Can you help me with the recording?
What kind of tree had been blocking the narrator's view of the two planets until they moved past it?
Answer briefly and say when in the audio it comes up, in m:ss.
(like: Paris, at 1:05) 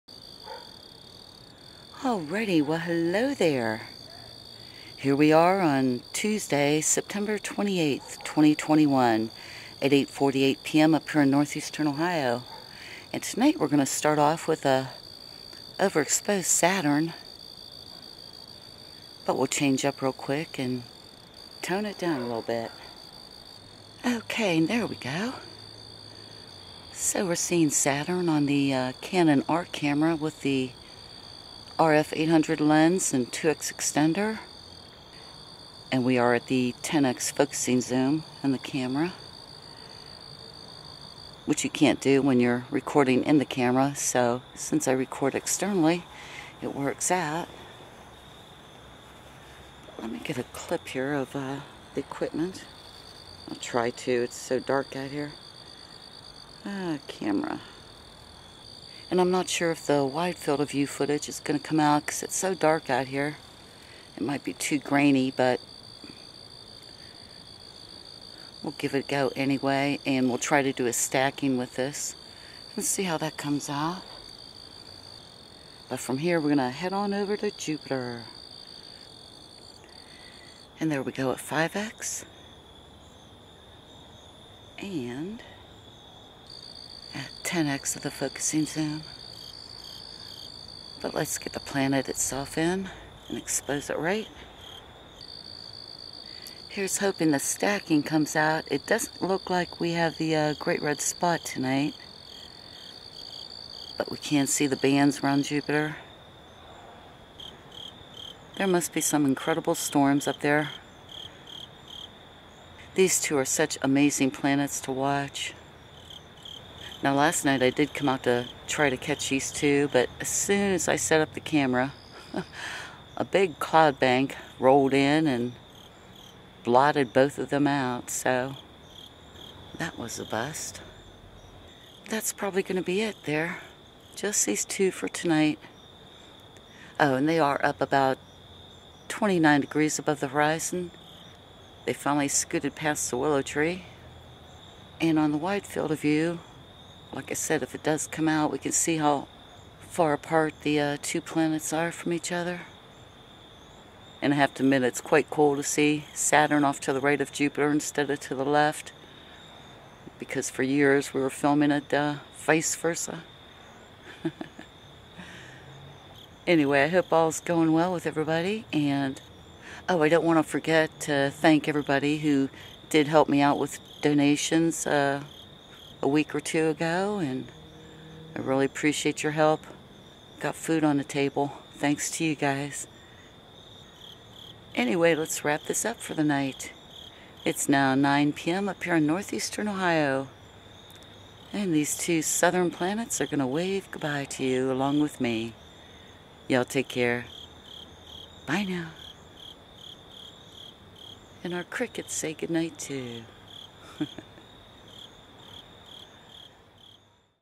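willow, at 2:23.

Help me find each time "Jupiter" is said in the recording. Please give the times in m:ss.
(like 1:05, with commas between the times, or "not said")
1:17, 1:45, 2:37.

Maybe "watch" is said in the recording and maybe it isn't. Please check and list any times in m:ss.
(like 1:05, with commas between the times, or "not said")
1:54.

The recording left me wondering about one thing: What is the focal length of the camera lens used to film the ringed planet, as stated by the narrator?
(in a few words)
800.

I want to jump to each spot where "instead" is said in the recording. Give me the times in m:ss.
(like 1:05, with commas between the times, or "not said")
2:37.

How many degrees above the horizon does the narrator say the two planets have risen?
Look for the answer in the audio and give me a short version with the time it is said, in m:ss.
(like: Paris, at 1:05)
29 degrees, at 2:19.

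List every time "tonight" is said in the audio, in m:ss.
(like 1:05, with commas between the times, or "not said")
0:13, 1:41, 2:15.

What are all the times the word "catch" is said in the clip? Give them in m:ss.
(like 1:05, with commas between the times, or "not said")
1:58.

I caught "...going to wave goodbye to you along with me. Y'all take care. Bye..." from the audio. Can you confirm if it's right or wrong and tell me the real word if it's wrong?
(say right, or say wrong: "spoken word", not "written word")
right.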